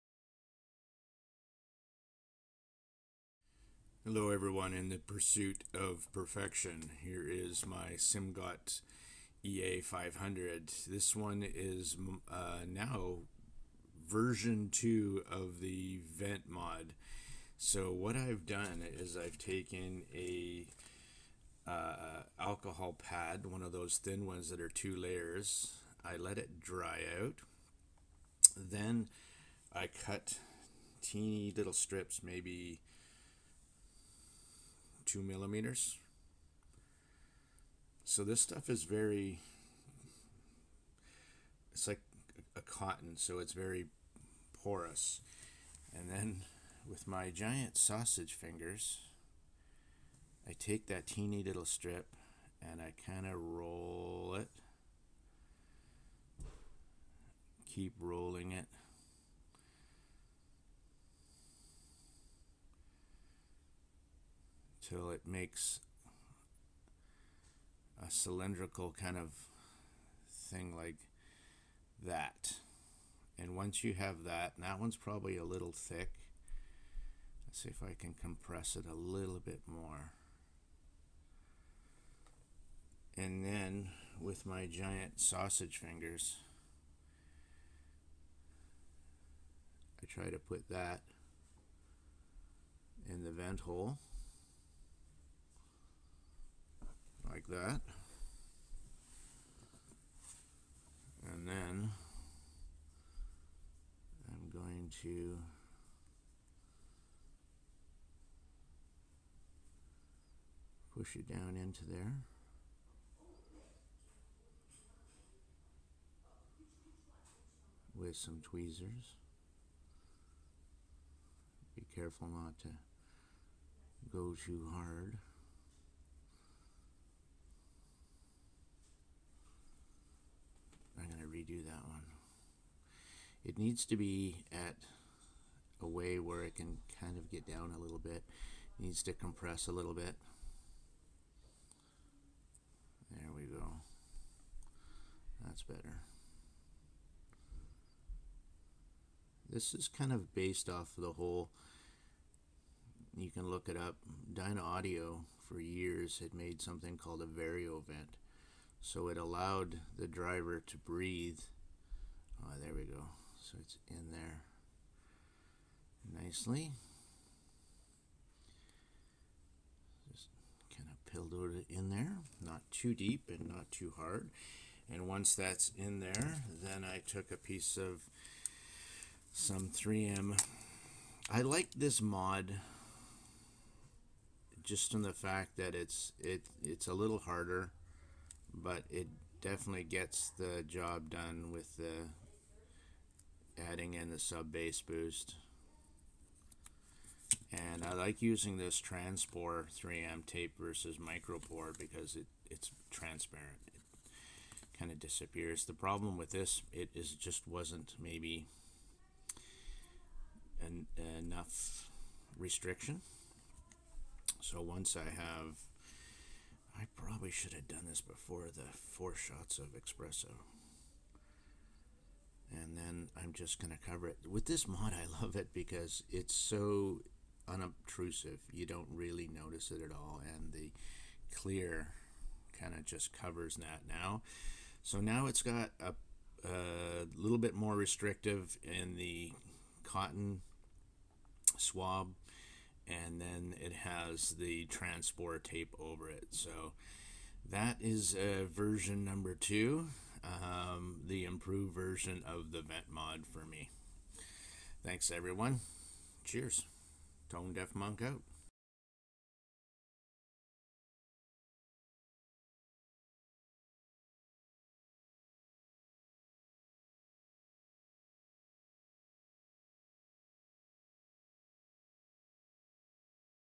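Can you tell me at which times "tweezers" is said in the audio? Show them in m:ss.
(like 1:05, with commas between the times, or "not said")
1:58.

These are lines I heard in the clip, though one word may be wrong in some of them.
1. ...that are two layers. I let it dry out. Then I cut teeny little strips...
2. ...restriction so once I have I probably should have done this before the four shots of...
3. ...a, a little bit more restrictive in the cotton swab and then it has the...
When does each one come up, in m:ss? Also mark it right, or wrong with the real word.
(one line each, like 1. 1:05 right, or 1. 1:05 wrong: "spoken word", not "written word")
1. 0:24 right
2. 3:32 right
3. 3:55 right.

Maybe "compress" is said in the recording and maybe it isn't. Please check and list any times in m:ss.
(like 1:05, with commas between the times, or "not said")
1:18, 2:19.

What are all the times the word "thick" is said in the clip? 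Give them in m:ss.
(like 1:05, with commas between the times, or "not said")
1:15.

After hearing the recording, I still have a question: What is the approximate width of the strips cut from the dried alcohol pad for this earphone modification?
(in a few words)
2 millimeters.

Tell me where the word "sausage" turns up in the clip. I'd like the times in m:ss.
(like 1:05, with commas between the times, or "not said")
0:47, 1:25.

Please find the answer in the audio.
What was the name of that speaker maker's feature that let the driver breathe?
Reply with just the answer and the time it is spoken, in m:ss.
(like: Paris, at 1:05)
Variovent, at 2:37.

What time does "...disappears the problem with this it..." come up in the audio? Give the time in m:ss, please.
3:24.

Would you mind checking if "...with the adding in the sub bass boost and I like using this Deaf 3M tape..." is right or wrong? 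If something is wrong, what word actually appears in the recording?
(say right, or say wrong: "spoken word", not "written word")
wrong: "Transpore", not "Deaf".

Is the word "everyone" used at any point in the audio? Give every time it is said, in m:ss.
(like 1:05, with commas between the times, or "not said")
0:04, 4:15.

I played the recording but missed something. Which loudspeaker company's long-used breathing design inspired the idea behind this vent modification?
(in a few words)
Dynaudio.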